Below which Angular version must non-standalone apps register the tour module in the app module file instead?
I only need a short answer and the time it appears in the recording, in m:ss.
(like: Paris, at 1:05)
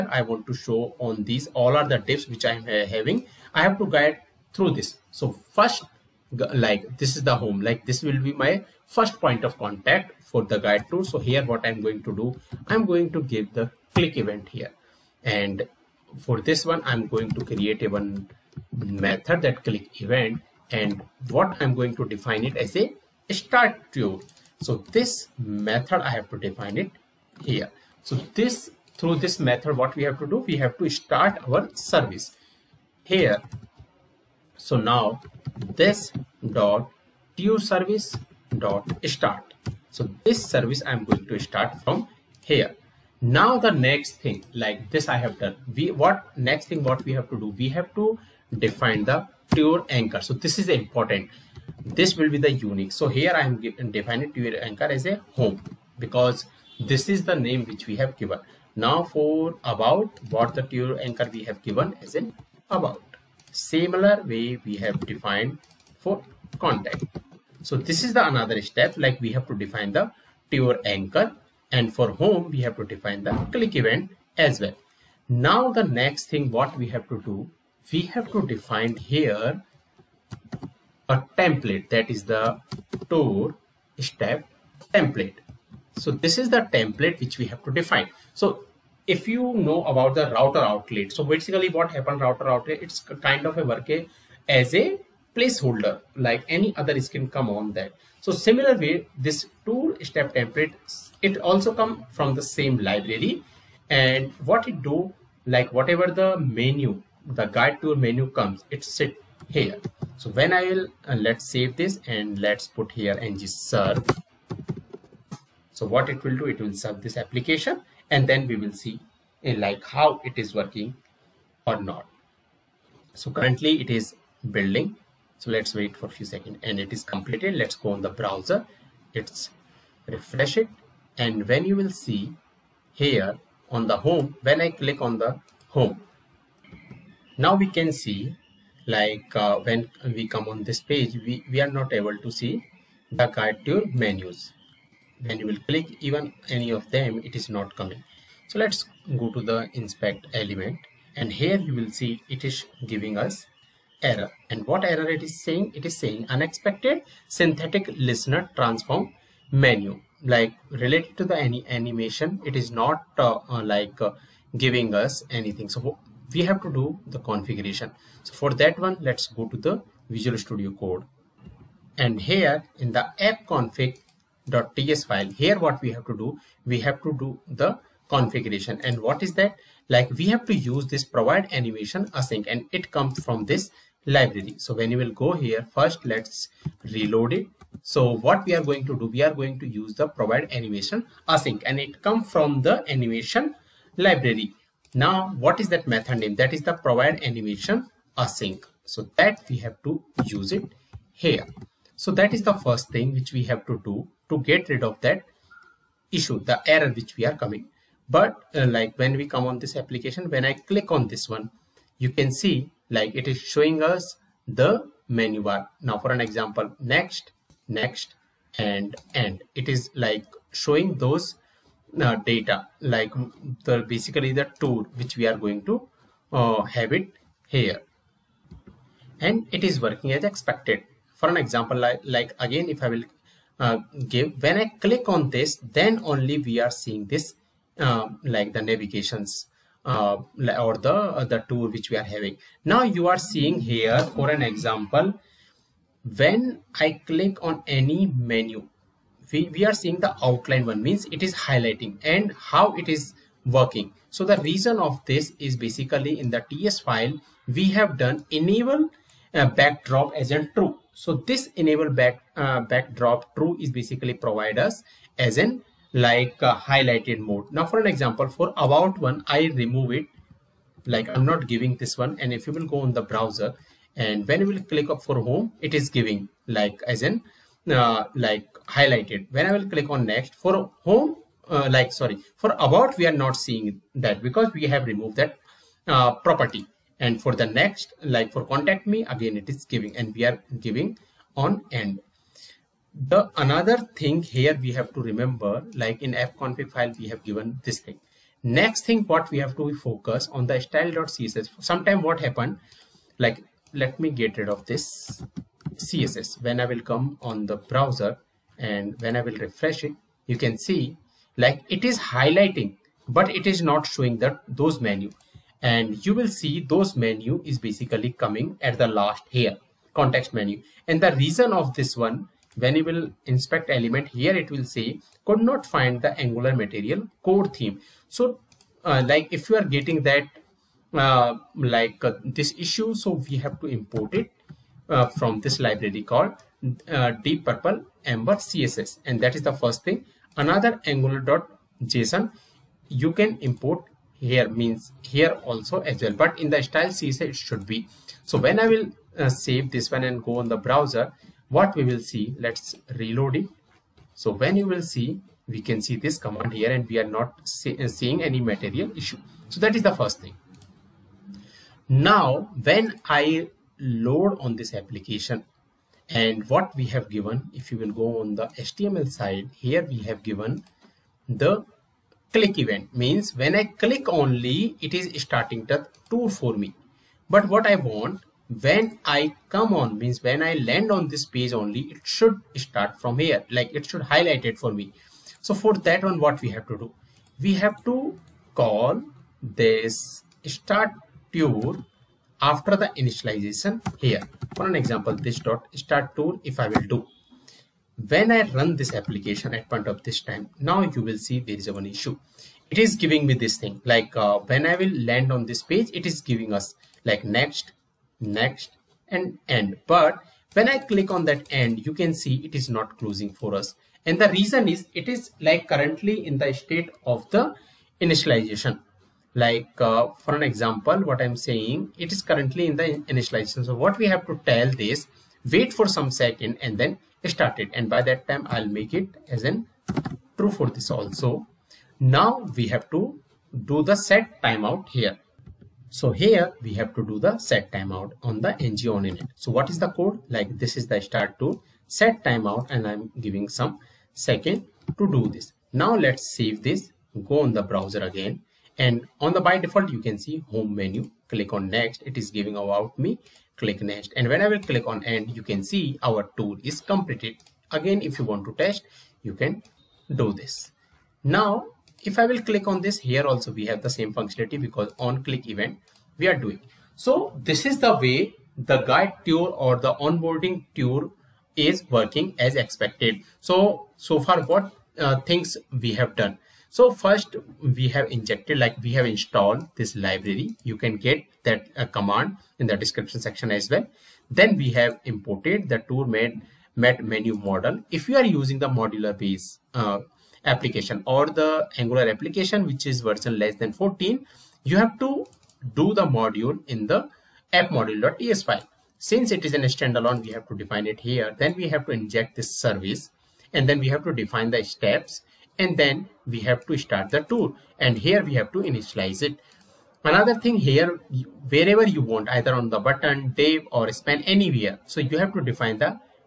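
14, at 8:13.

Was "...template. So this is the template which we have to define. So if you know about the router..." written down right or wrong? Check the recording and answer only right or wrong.
right.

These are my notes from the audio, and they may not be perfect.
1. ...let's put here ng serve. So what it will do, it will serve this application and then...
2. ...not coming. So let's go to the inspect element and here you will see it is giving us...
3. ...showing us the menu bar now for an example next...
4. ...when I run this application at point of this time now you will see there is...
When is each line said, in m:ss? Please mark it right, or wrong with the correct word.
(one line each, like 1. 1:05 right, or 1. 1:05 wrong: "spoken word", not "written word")
1. 1:52 right
2. 2:27 right
3. 3:33 right
4. 6:38 right.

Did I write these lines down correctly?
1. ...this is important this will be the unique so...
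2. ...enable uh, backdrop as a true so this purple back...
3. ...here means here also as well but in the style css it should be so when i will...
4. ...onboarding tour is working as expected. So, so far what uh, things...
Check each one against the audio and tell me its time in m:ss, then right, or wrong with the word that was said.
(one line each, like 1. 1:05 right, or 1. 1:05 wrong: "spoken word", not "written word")
1. 0:50 right
2. 4:18 wrong: "enable", not "purple"
3. 5:44 right
4. 7:49 right.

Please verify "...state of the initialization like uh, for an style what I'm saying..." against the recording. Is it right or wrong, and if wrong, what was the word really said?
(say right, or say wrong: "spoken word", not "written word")
wrong: "example", not "style".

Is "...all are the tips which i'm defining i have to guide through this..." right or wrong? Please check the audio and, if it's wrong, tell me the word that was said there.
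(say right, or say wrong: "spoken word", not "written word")
wrong: "having", not "defining".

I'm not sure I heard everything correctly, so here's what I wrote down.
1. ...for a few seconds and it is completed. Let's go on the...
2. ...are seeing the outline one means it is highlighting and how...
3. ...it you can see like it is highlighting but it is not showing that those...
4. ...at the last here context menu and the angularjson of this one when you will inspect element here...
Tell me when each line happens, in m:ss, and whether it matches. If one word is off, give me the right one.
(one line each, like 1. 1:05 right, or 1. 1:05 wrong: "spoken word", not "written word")
1. 2:05 right
2. 4:09 right
3. 5:09 right
4. 5:18 wrong: "reason", not "angularjson".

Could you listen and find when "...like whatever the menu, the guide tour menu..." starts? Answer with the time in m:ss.
1:45.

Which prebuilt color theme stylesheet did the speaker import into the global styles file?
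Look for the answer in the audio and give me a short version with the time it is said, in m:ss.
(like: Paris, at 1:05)
deep purple amber, at 5:37.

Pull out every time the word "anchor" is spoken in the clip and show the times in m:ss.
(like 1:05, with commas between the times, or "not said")
0:49, 0:54, 1:01, 1:10.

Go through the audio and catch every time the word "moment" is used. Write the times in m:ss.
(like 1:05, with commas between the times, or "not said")
not said.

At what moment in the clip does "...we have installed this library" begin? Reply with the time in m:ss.
7:58.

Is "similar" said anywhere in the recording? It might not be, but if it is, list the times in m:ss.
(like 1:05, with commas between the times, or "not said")
1:03, 1:38.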